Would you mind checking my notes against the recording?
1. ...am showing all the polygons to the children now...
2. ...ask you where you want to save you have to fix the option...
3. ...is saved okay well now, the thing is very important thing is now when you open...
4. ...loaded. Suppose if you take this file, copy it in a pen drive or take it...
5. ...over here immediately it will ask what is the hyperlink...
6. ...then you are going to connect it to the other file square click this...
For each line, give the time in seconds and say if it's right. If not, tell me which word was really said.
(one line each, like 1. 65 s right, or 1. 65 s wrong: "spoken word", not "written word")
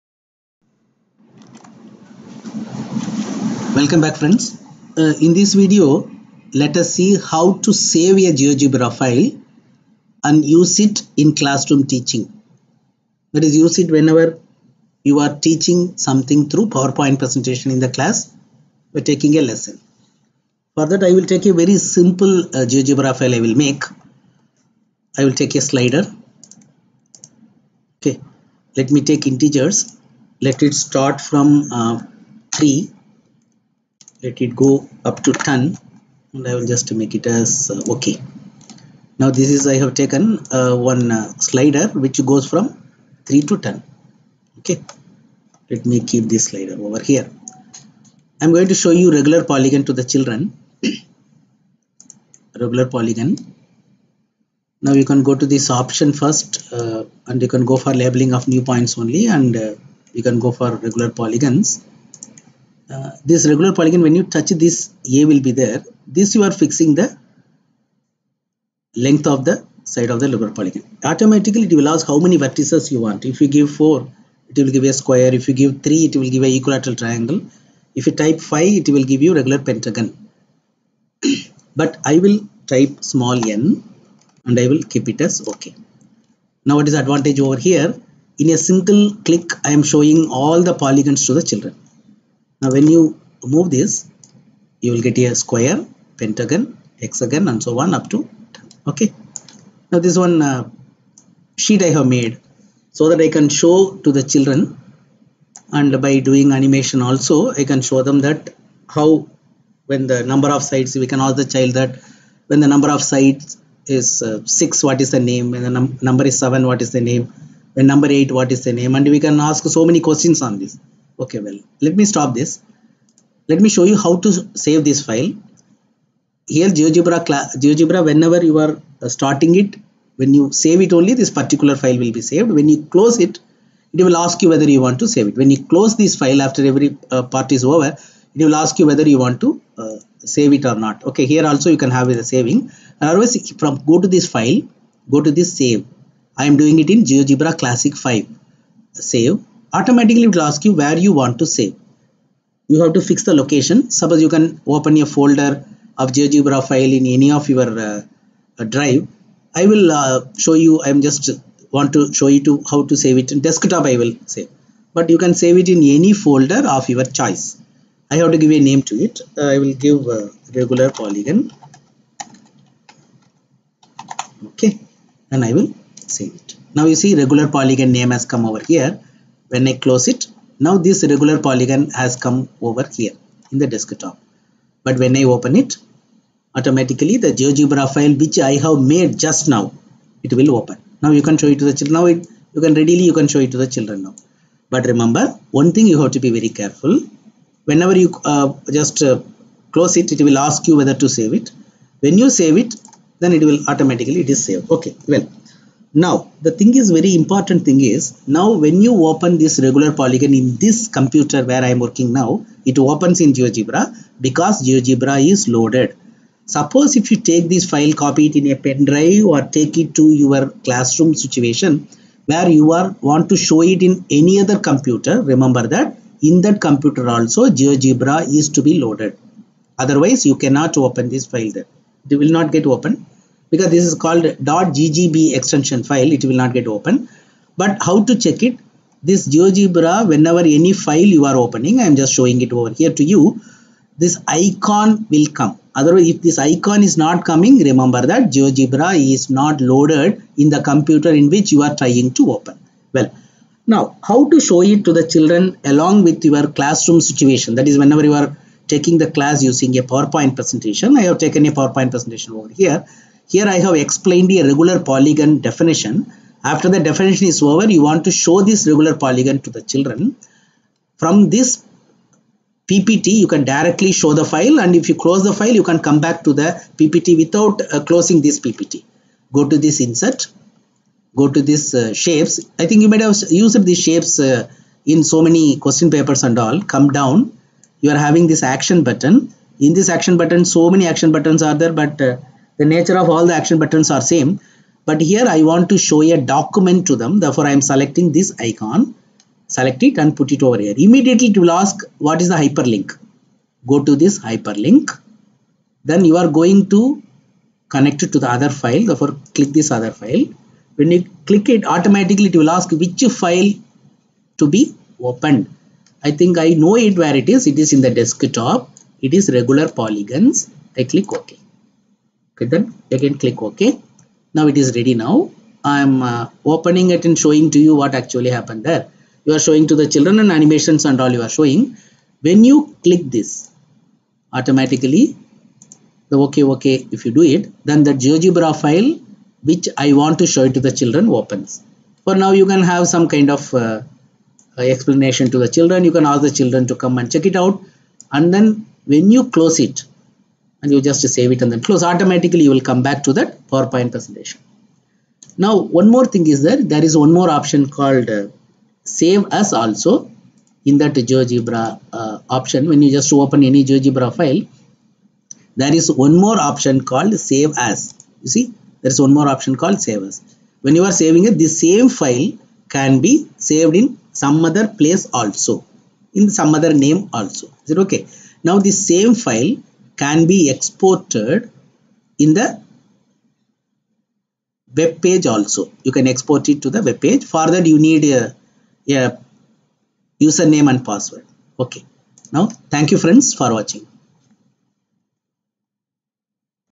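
1. 89 s right
2. 150 s wrong: "location", not "option"
3. 204 s right
4. 215 s right
5. 300 s right
6. 305 s wrong: "therefore", not "square".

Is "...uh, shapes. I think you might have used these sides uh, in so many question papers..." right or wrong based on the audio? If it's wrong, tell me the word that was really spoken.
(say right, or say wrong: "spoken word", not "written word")
wrong: "shapes", not "sides".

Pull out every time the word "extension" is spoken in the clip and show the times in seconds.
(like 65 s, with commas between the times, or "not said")
235 s.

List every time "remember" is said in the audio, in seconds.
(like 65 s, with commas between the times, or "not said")
194 s, 225 s, 247 s.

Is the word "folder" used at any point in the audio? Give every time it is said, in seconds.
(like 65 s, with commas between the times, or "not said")
155 s, 166 s.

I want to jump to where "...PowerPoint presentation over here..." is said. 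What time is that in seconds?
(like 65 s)
261 s.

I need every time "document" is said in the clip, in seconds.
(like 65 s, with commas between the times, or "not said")
296 s.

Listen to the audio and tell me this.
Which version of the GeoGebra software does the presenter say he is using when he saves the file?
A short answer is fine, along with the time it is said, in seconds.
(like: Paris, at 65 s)
GeoGebra Classic 5, at 147 s.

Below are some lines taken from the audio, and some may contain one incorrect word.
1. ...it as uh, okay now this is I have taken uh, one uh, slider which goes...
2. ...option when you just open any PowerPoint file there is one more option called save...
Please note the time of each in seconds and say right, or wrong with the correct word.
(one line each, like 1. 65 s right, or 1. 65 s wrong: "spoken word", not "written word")
1. 37 s right
2. 362 s wrong: "GeoGebra", not "PowerPoint".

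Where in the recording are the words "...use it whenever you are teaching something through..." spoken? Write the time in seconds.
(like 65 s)
13 s.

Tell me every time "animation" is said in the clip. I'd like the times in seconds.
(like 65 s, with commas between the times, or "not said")
106 s, 330 s.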